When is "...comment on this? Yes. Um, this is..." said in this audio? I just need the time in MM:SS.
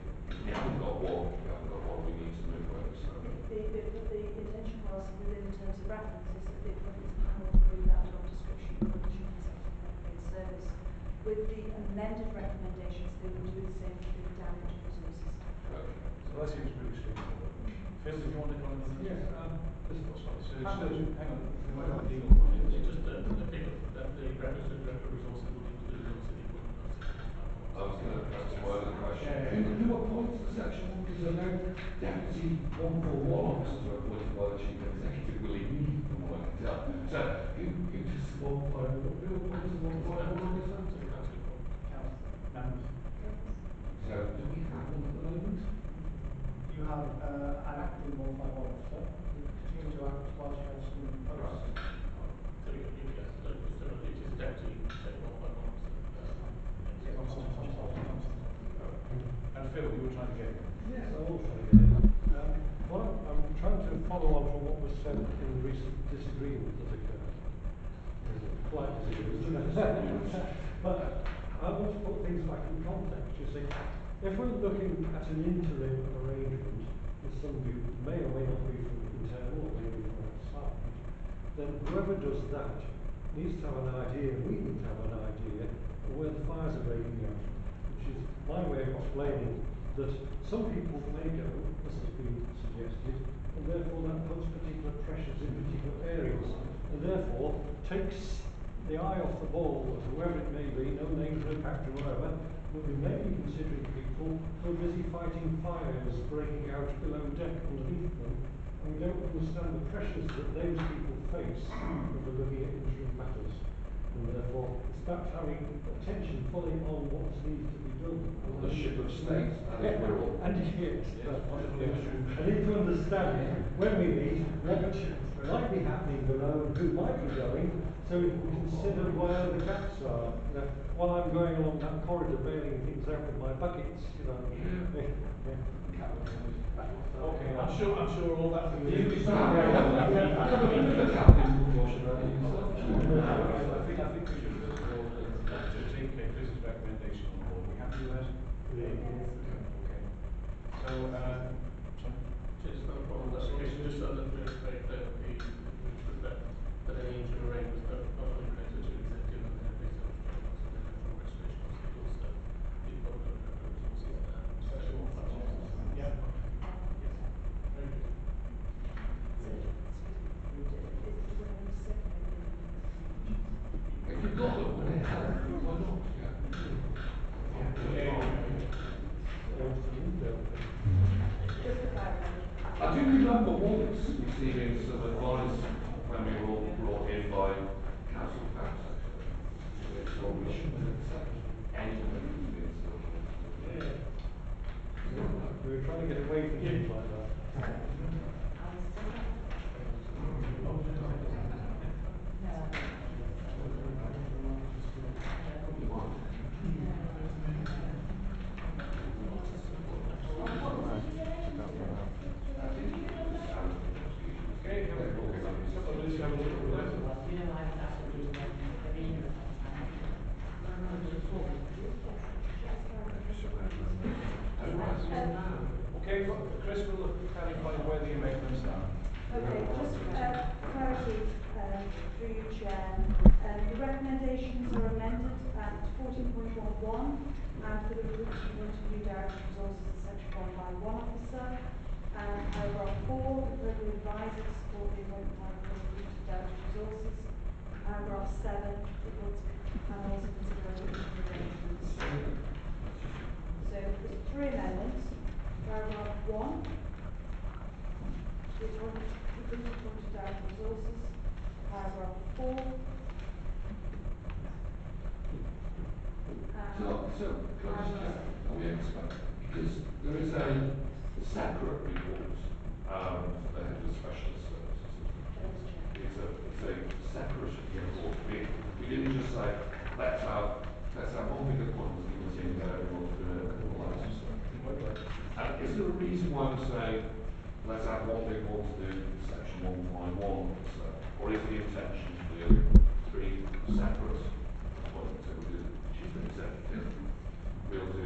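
00:18.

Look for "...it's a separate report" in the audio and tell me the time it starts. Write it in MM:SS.
04:36.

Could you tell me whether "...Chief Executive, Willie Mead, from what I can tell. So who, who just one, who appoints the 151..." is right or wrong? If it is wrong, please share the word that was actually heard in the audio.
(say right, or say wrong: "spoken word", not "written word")
right.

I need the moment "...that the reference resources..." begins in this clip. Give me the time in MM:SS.
00:23.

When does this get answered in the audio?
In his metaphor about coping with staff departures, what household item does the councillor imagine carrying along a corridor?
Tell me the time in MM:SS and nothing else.
02:13.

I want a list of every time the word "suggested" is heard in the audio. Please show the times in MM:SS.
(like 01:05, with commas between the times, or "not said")
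01:32.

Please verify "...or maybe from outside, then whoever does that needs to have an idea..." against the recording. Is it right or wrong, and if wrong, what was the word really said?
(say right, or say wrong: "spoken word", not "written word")
right.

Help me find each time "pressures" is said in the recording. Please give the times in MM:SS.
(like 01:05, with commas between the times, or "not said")
01:35, 01:49.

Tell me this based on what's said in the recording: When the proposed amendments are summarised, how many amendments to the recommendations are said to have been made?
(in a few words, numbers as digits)
3.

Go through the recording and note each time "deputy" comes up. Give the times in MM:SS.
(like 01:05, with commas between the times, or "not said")
00:31, 00:54.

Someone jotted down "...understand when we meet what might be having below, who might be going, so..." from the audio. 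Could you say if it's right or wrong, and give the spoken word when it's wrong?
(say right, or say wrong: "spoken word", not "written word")
wrong: "happening", not "having".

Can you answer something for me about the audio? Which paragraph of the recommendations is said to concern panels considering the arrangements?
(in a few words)
Paragraph 7.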